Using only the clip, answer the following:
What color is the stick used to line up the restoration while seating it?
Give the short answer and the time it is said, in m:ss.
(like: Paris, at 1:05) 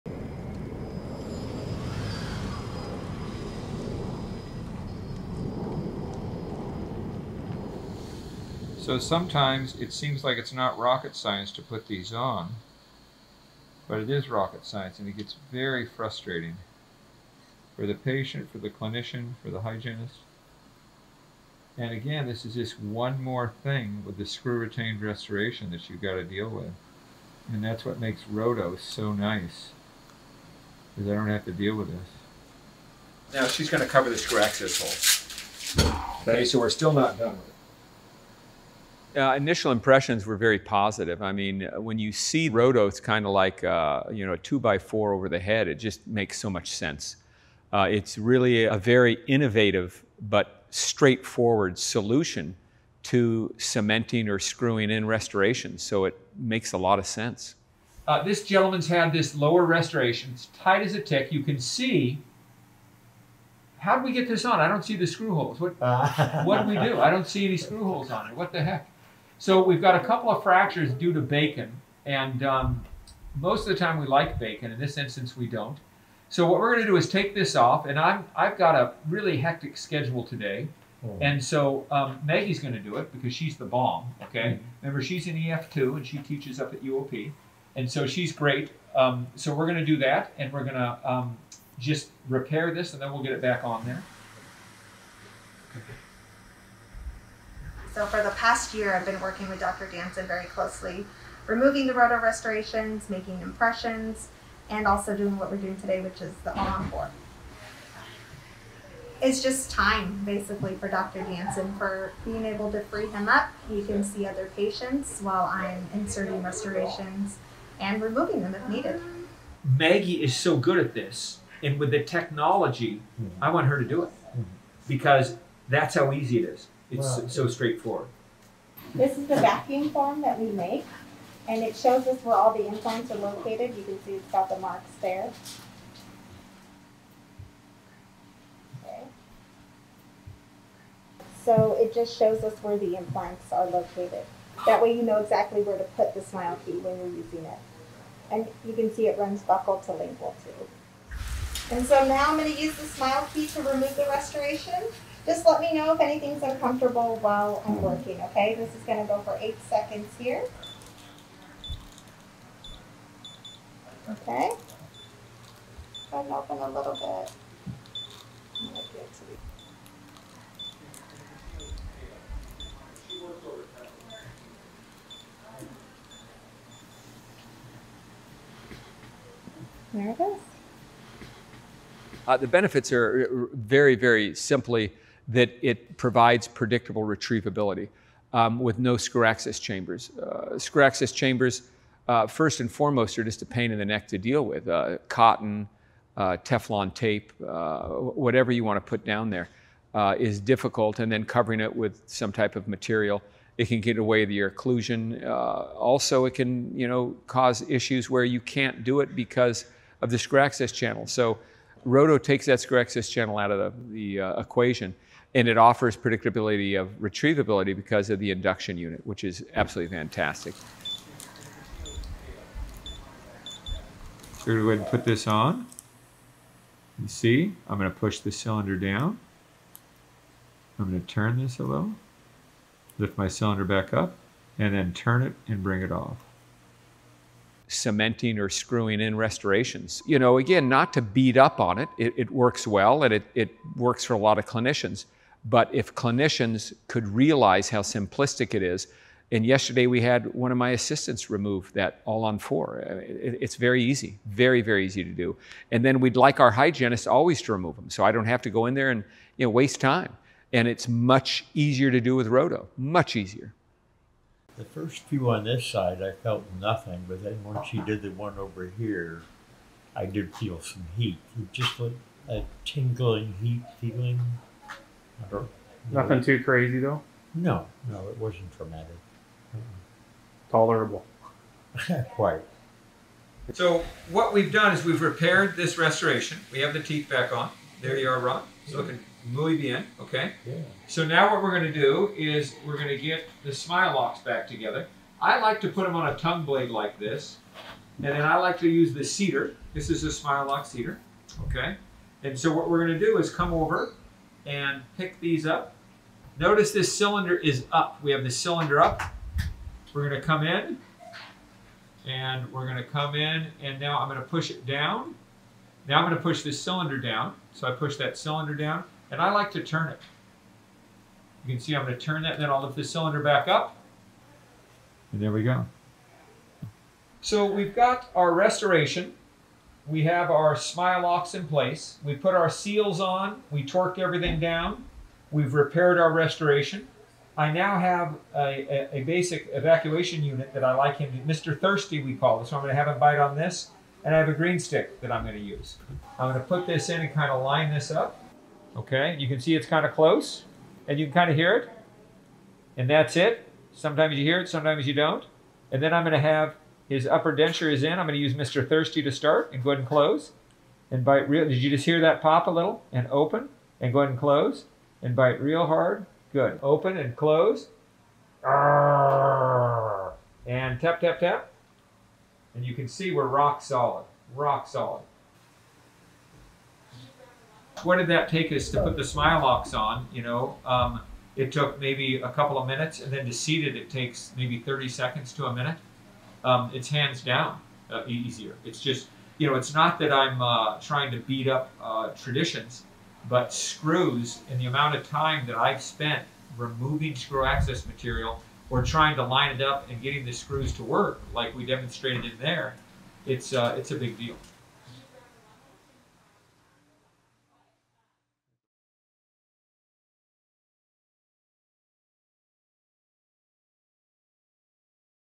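green, at 5:44.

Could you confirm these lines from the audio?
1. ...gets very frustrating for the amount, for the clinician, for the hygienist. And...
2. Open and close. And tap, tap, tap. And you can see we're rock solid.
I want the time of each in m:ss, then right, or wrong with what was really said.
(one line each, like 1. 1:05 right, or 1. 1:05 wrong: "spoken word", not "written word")
1. 0:15 wrong: "patient", not "amount"
2. 6:06 right.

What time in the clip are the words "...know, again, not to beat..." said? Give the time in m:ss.
4:00.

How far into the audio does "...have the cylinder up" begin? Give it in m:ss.
5:08.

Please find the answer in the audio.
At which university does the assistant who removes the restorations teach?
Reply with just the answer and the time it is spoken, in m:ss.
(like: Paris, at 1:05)
UOP, at 1:26.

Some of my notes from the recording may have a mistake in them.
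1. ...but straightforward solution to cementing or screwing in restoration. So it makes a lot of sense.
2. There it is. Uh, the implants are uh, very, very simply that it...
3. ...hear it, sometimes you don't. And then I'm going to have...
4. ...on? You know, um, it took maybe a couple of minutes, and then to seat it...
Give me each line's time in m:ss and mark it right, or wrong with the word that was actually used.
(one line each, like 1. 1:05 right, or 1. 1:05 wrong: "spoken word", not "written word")
1. 0:50 right
2. 2:59 wrong: "benefits", not "implants"
3. 5:54 right
4. 6:19 right.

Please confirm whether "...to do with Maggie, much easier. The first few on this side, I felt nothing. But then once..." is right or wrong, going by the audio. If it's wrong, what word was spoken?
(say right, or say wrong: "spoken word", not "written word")
wrong: "RODO", not "Maggie".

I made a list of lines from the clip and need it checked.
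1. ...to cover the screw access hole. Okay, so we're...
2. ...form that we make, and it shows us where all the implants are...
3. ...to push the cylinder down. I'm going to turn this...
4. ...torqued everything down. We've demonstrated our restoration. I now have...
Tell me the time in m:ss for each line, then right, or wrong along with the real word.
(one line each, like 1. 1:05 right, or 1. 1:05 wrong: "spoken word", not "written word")
1. 0:33 right
2. 2:09 right
3. 3:47 right
4. 5:33 wrong: "repaired", not "demonstrated".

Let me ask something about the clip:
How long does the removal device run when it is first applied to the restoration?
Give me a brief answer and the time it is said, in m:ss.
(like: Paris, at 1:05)
8 seconds, at 2:39.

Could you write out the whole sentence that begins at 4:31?
It just like a tingling heat feeling.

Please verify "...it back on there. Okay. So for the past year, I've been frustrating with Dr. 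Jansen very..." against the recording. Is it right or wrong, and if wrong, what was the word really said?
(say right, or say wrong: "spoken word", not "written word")
wrong: "working", not "frustrating".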